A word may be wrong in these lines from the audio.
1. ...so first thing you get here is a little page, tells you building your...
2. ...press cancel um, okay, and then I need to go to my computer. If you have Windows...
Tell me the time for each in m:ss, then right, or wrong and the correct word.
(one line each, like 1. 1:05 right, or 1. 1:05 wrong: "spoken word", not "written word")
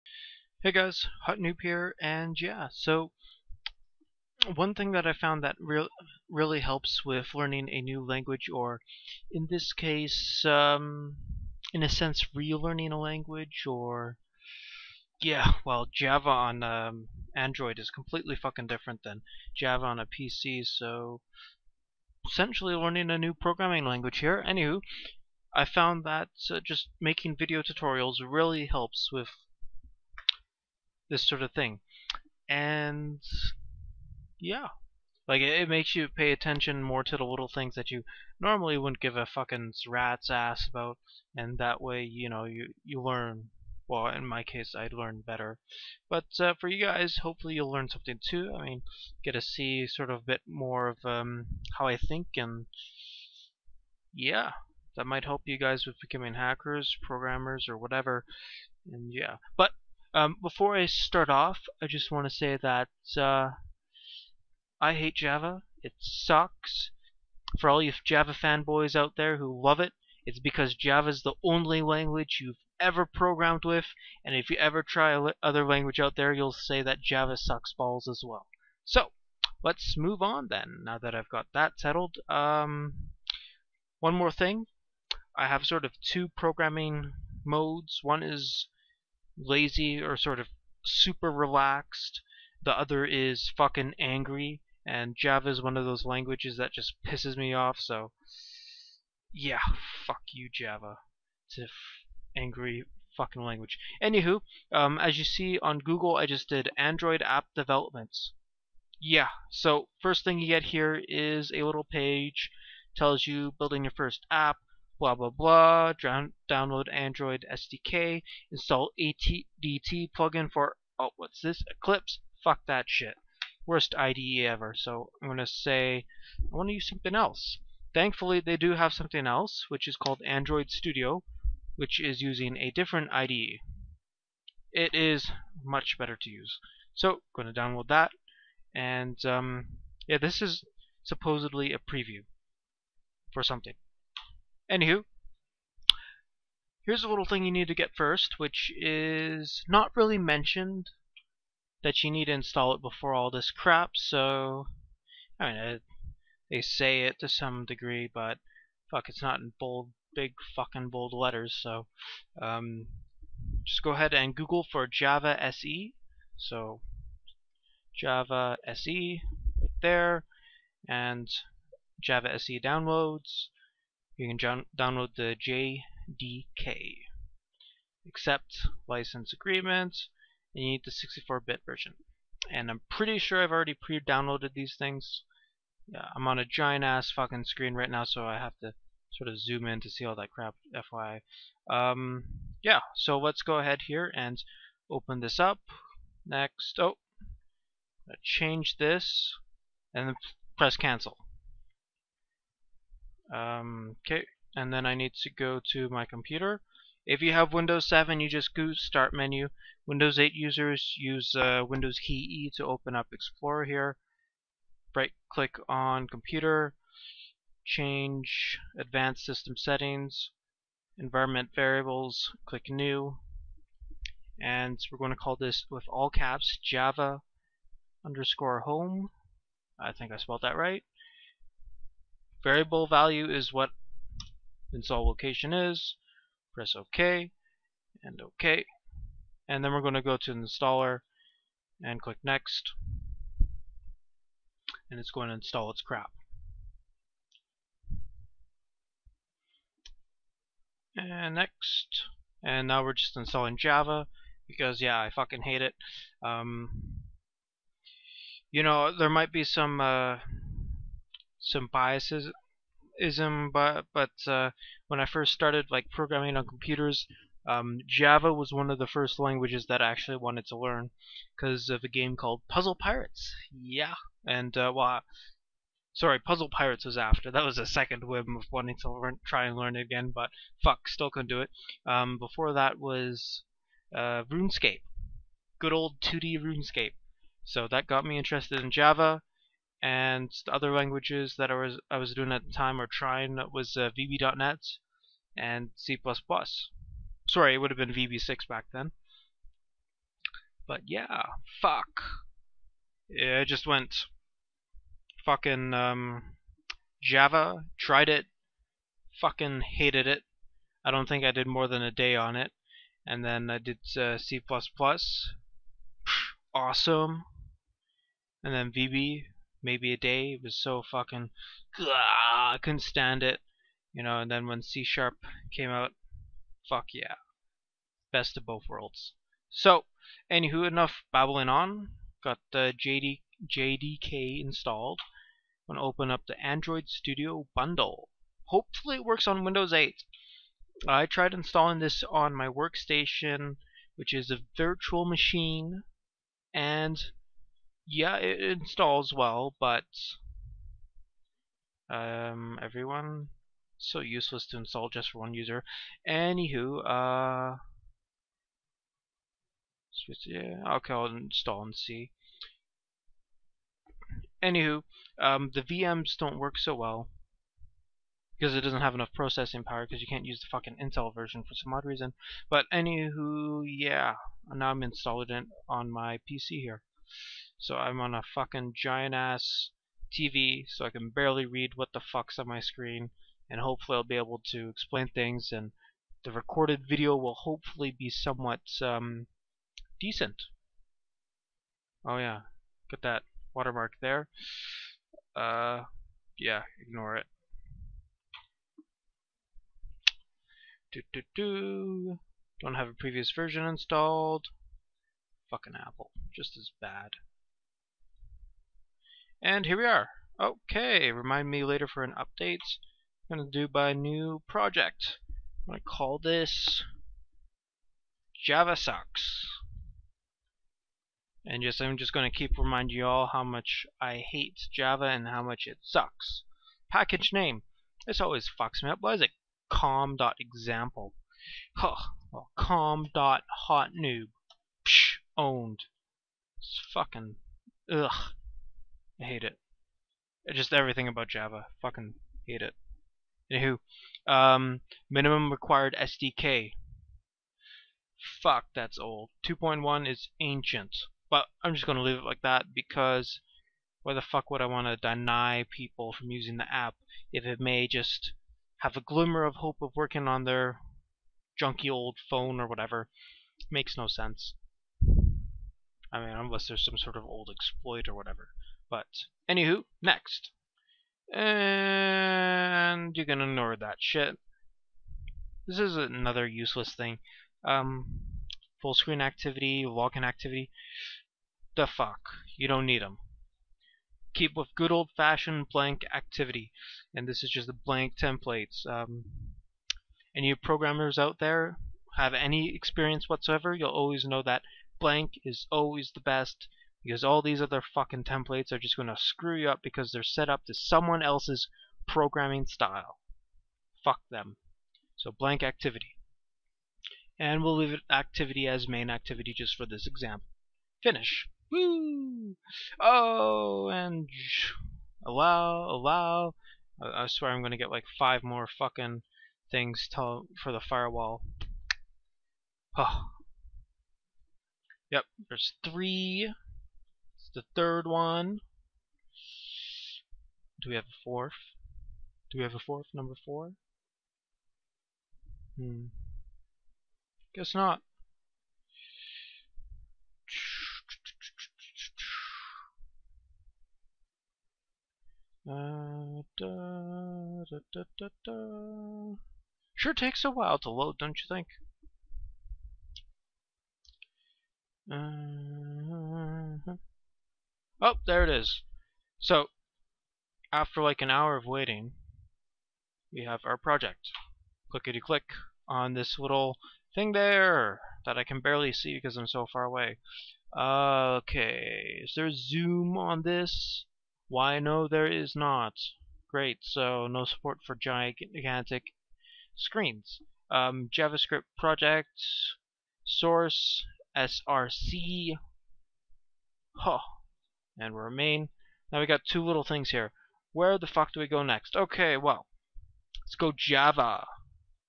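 1. 1:49 right
2. 3:20 right.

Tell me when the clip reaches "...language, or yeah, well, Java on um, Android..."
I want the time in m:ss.
0:12.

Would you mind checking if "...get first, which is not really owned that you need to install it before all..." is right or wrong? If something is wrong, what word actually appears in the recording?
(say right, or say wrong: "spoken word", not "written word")
wrong: "mentioned", not "owned".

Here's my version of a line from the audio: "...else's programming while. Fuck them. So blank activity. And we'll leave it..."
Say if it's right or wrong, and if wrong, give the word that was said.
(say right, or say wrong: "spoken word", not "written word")
wrong: "style", not "while".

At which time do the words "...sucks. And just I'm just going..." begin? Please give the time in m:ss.
6:58.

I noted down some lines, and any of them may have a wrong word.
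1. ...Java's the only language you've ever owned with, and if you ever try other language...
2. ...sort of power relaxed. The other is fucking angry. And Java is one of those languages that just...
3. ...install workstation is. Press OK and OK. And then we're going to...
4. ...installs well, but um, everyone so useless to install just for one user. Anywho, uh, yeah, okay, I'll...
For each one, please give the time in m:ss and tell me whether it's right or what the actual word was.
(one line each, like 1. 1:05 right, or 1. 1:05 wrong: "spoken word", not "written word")
1. 1:10 wrong: "programmed", not "owned"
2. 1:30 wrong: "super", not "power"
3. 3:54 wrong: "location", not "workstation"
4. 5:48 right.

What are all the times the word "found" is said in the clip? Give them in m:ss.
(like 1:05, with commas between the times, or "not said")
0:05, 0:25.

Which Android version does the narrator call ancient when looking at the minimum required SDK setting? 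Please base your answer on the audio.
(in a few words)
2.1.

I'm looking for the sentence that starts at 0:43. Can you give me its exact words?
Well, in my case, I would learn better, but uh, for you guys, hopefully you'll learn something too.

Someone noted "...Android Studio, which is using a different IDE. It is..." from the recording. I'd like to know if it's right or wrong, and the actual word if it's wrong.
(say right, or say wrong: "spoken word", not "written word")
right.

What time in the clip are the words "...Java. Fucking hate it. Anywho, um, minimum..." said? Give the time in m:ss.
7:21.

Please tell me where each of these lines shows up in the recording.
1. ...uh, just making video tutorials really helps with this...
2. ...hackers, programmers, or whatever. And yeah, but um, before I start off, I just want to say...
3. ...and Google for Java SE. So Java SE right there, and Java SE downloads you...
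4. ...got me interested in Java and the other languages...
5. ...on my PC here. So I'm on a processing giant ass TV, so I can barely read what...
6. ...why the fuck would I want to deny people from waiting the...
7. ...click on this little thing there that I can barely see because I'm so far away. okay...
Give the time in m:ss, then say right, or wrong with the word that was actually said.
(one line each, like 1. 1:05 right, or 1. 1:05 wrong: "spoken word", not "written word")
1. 0:26 right
2. 0:56 right
3. 2:44 right
4. 4:47 right
5. 6:15 wrong: "fucking", not "processing"
6. 7:34 wrong: "using", not "waiting"
7. 9:25 right.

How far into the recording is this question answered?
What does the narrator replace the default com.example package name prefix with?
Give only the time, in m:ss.
7:12.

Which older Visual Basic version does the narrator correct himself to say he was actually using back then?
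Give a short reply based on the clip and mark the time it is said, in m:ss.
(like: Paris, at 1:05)
VB6, at 4:57.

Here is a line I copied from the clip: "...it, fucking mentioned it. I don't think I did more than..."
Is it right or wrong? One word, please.
wrong.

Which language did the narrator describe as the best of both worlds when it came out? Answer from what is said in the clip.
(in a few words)
C Sharp.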